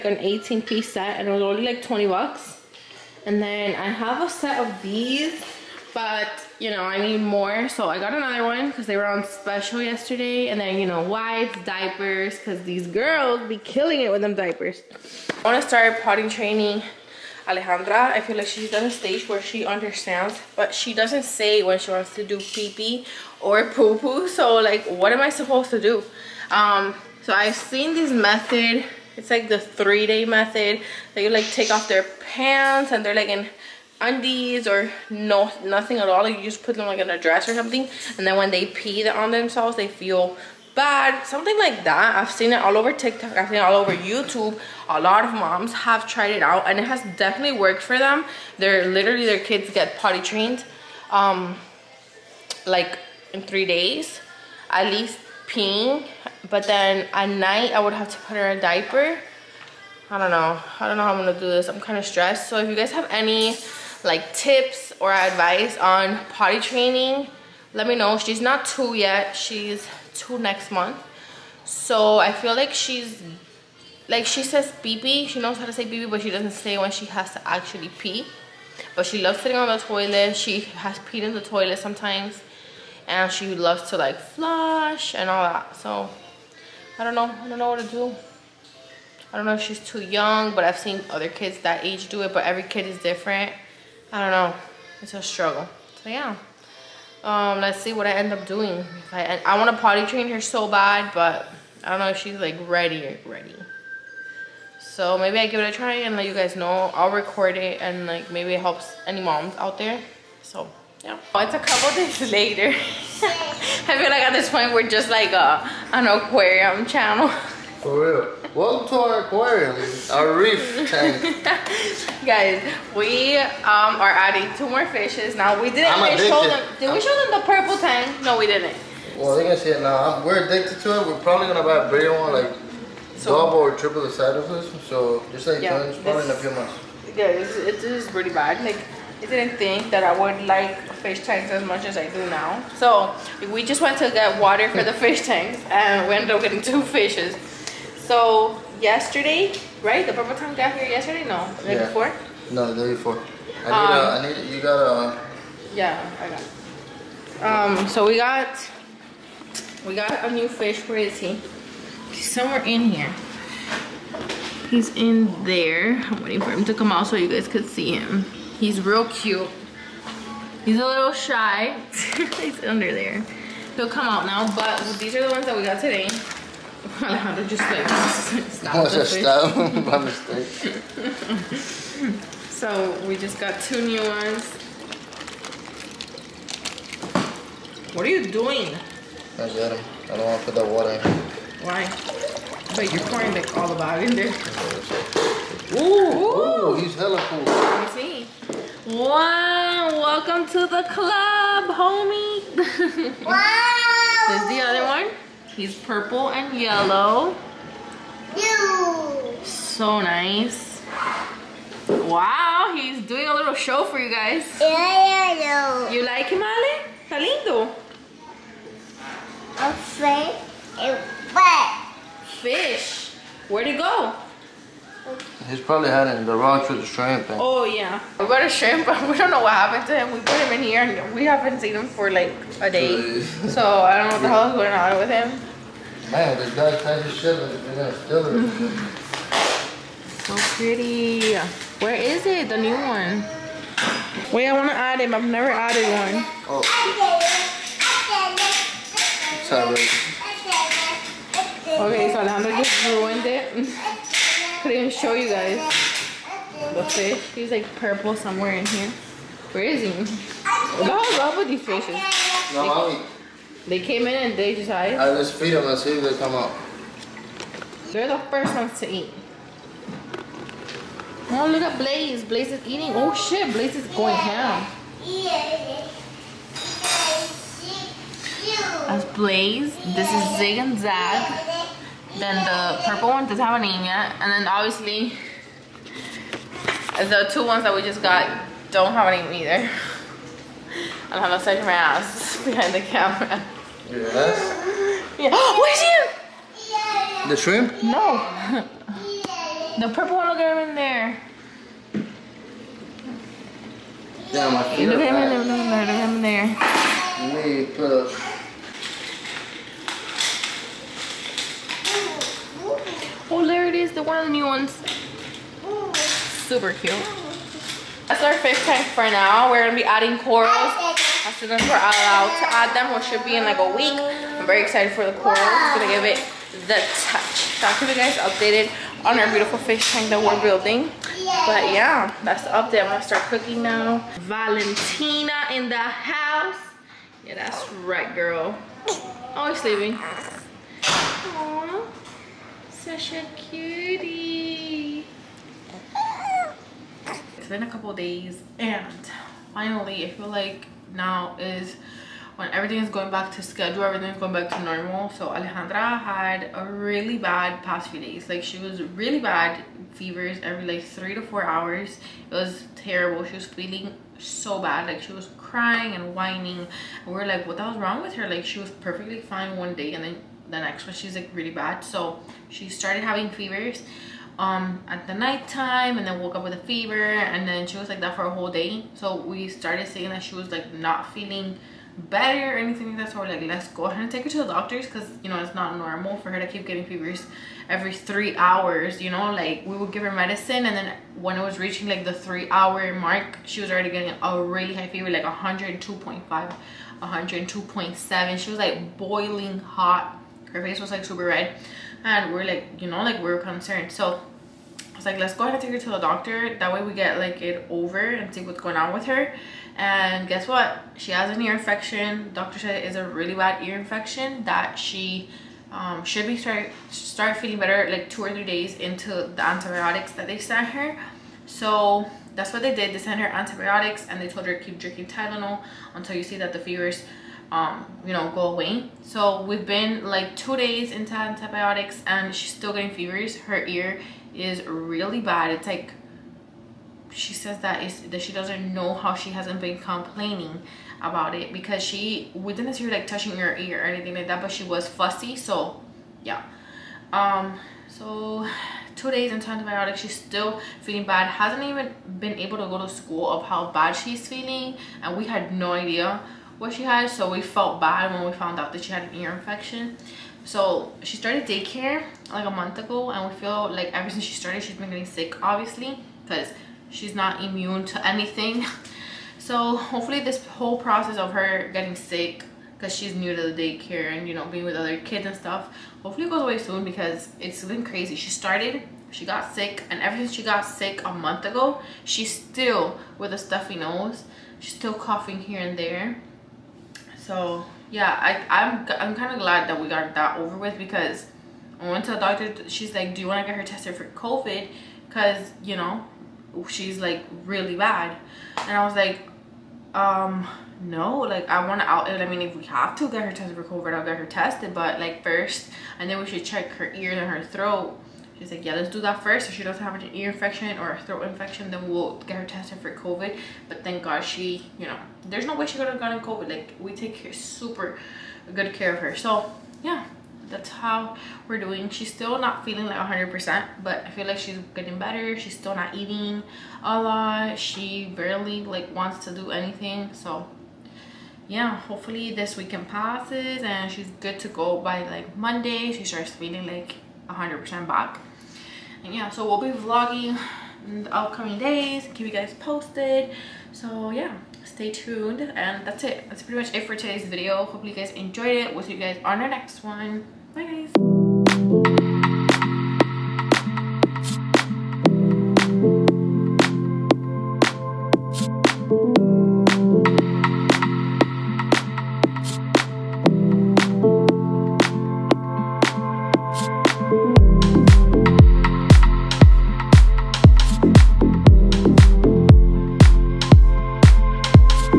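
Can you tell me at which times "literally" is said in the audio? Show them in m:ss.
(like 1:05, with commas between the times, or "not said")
0:48.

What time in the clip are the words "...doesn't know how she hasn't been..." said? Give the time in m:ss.
7:18.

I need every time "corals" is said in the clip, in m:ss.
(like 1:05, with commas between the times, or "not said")
5:20, 5:25.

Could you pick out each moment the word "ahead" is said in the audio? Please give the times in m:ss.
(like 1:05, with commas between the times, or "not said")
6:23, 6:45.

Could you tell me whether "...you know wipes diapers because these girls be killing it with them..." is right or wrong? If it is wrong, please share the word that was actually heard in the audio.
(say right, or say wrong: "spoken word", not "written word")
right.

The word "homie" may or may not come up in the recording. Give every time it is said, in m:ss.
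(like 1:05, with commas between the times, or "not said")
3:21.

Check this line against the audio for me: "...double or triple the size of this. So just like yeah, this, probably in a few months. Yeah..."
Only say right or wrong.
right.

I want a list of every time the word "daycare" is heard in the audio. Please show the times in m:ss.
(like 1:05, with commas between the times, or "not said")
7:41, 7:53.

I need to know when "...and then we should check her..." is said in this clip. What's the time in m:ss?
8:25.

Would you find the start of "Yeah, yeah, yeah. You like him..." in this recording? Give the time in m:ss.
3:34.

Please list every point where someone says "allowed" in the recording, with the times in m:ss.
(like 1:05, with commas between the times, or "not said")
5:21.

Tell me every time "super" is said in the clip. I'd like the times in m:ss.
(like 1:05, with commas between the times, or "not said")
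5:16, 6:41, 8:37.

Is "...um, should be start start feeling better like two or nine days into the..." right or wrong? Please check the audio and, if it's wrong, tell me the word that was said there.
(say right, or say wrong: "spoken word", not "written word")
wrong: "three", not "nine".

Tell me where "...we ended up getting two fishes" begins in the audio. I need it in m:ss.
2:26.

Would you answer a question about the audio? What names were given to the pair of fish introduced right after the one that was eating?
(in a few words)
Zig and Zag.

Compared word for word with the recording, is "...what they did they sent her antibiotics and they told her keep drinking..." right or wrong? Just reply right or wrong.
right.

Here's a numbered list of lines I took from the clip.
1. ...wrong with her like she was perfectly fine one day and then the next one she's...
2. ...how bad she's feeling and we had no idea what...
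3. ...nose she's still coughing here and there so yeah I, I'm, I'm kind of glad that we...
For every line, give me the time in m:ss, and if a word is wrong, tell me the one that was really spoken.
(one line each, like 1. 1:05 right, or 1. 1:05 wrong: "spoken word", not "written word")
1. 6:07 right
2. 7:33 right
3. 8:03 right.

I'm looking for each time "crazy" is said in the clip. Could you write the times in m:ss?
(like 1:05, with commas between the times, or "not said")
7:57.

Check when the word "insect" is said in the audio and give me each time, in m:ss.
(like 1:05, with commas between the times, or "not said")
not said.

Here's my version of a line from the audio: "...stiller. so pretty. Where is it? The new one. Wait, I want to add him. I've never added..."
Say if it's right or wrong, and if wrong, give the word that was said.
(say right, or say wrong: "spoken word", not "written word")
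right.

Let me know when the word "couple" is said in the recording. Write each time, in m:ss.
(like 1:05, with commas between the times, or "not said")
1:51, 5:47.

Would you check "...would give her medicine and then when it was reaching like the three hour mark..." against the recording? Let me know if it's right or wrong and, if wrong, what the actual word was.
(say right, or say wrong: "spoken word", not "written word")
right.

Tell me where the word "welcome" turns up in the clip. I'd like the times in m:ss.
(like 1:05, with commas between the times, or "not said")
1:58, 3:19.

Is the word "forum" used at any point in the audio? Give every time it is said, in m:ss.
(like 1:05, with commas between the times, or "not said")
not said.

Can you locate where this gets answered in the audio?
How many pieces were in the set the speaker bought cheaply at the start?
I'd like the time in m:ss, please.
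0:00.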